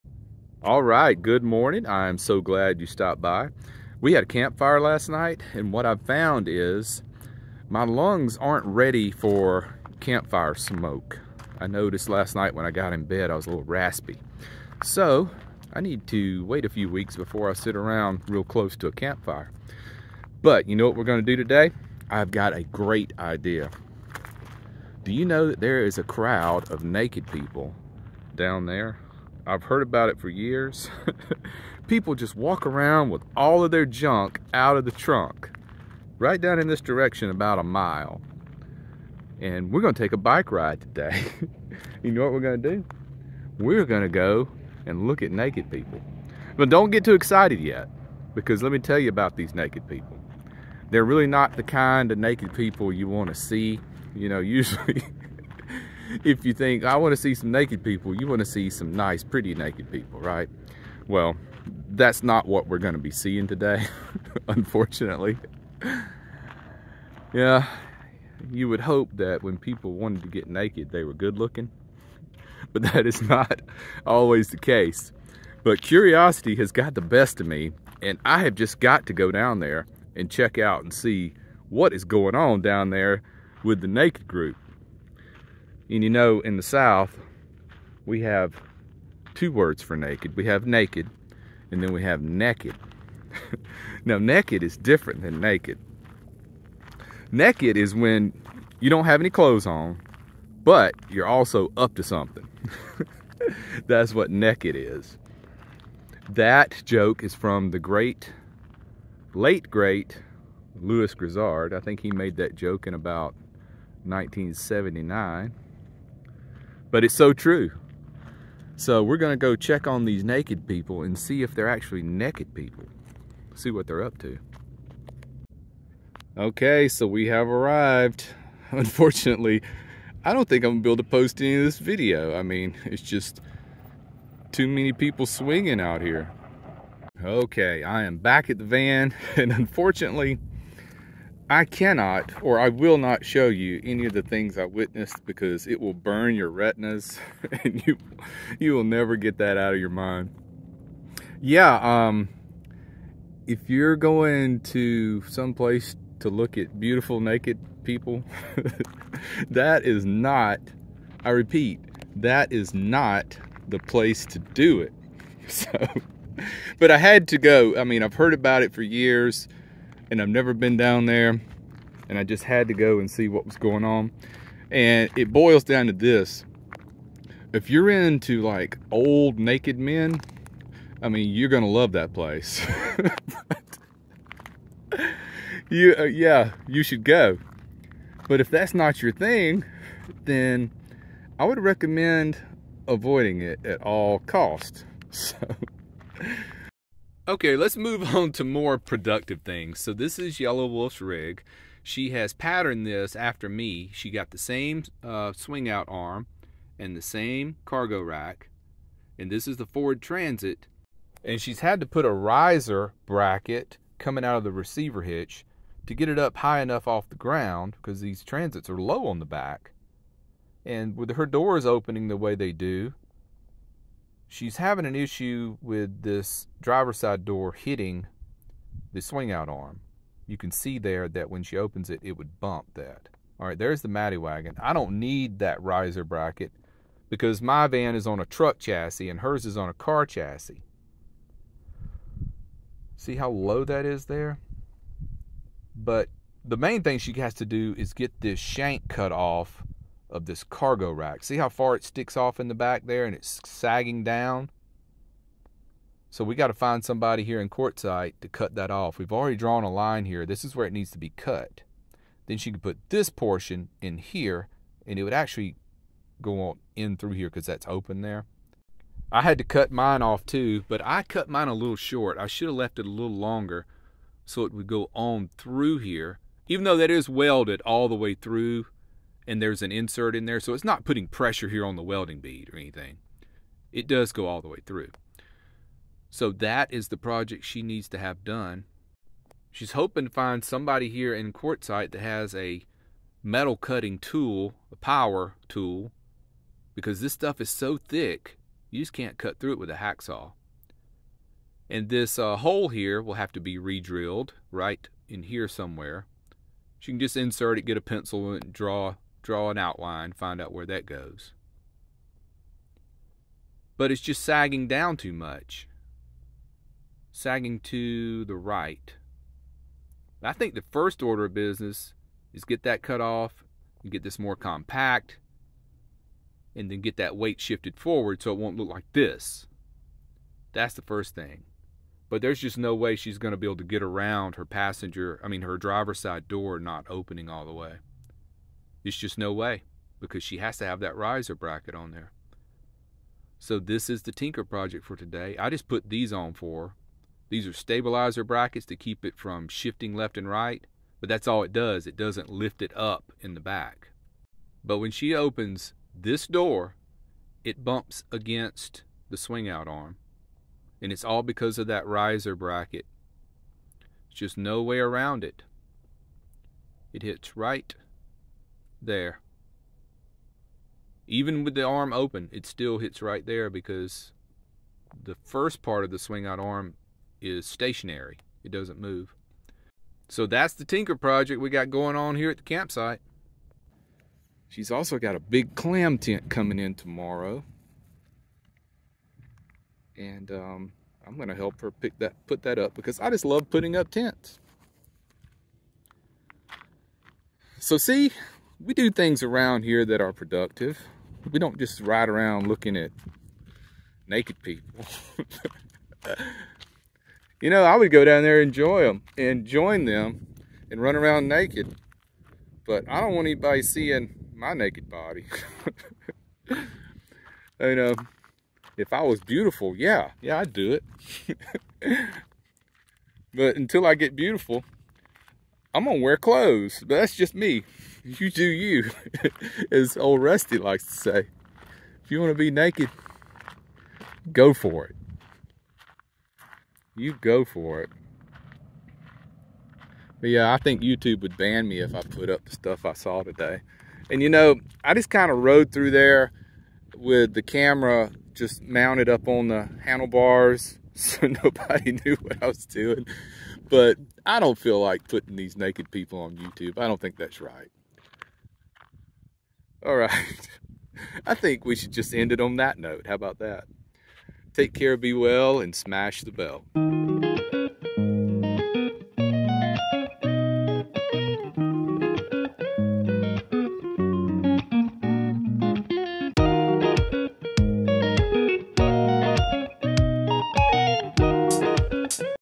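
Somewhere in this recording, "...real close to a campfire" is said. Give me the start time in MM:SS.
00:18.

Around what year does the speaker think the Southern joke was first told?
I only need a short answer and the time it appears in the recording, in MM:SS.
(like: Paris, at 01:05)
1979, at 01:54.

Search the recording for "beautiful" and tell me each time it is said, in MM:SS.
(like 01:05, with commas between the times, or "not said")
02:36, 06:59, 07:04.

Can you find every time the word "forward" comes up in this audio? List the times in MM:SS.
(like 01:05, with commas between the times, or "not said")
05:27.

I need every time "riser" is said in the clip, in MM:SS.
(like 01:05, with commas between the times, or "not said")
03:32, 03:55, 05:40, 06:01.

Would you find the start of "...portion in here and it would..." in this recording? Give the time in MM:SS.
04:23.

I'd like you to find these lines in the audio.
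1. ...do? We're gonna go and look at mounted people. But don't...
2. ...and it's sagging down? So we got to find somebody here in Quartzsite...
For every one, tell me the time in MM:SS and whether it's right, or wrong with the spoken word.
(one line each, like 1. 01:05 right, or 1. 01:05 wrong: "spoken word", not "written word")
1. 00:42 wrong: "naked", not "mounted"
2. 04:13 right.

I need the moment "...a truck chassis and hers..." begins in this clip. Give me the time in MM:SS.
03:58.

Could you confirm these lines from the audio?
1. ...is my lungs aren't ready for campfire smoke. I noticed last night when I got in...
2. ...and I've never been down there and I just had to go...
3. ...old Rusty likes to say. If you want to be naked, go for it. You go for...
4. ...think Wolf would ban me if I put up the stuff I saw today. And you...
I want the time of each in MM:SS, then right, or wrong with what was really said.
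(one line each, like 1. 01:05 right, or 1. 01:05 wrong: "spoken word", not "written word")
1. 00:06 right
2. 02:50 right
3. 07:09 right
4. 07:20 wrong: "YouTube", not "Wolf".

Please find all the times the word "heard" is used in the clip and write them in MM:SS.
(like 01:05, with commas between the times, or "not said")
00:29, 02:48.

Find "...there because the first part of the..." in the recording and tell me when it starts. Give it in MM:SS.
06:13.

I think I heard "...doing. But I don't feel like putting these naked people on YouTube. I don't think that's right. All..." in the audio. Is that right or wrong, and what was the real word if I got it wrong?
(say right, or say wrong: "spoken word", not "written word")
right.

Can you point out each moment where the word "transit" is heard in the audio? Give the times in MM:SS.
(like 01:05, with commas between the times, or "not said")
03:30, 03:38.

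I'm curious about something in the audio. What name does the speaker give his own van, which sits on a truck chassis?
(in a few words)
The Matty wagon.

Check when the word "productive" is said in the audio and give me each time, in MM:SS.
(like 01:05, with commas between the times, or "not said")
03:18, 06:40.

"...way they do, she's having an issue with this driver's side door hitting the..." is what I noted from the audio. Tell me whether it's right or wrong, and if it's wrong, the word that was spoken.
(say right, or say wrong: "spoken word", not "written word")
right.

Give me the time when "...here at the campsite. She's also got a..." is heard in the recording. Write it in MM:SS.
06:22.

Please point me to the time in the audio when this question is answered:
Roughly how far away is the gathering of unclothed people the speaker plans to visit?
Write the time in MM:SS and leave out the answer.
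00:37.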